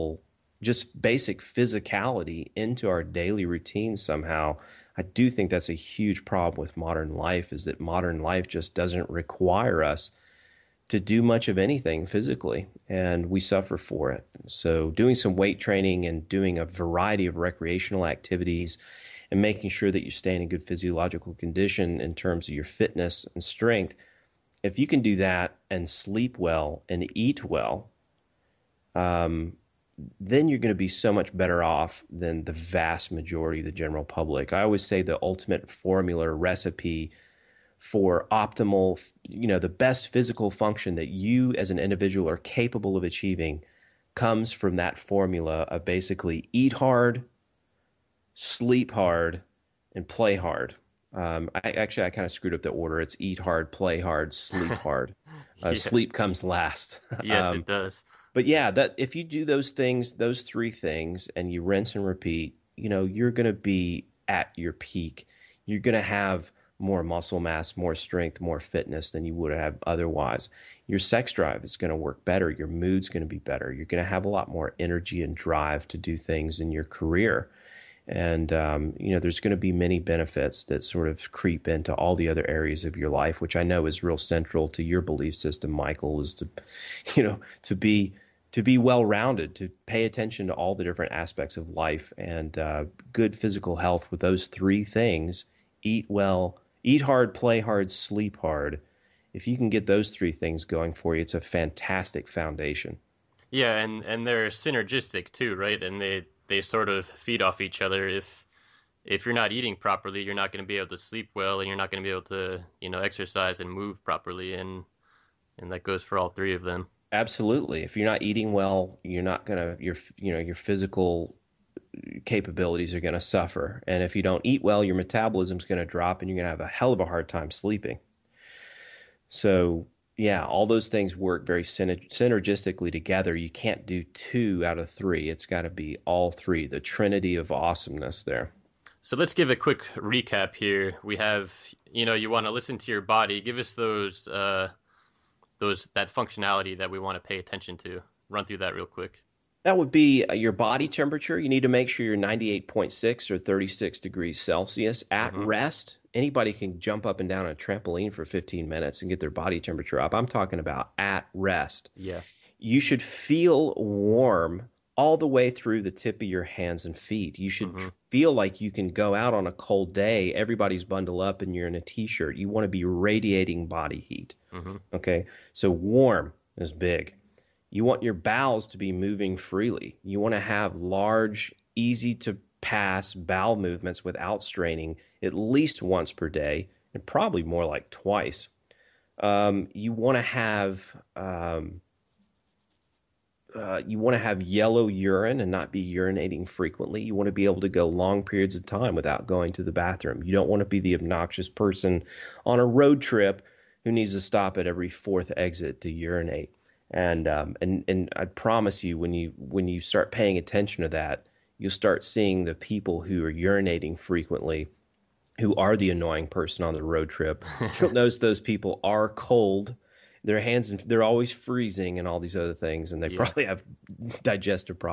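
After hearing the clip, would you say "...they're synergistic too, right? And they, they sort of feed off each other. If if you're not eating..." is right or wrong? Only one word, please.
right.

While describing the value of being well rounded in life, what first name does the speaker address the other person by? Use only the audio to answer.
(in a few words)
Michael.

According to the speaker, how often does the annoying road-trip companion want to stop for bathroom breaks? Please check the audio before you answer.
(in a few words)
every fourth exit.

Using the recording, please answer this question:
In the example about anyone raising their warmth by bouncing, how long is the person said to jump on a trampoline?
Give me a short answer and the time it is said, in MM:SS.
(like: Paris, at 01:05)
15 minutes, at 02:38.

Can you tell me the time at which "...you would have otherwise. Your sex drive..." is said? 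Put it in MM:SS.
01:09.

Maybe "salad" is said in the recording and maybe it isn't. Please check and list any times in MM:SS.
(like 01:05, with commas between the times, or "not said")
not said.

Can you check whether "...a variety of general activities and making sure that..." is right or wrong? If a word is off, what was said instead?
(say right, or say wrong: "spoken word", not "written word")
wrong: "recreational", not "general".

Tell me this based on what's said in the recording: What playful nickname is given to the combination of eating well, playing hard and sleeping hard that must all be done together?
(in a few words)
the trinity of awesomeness.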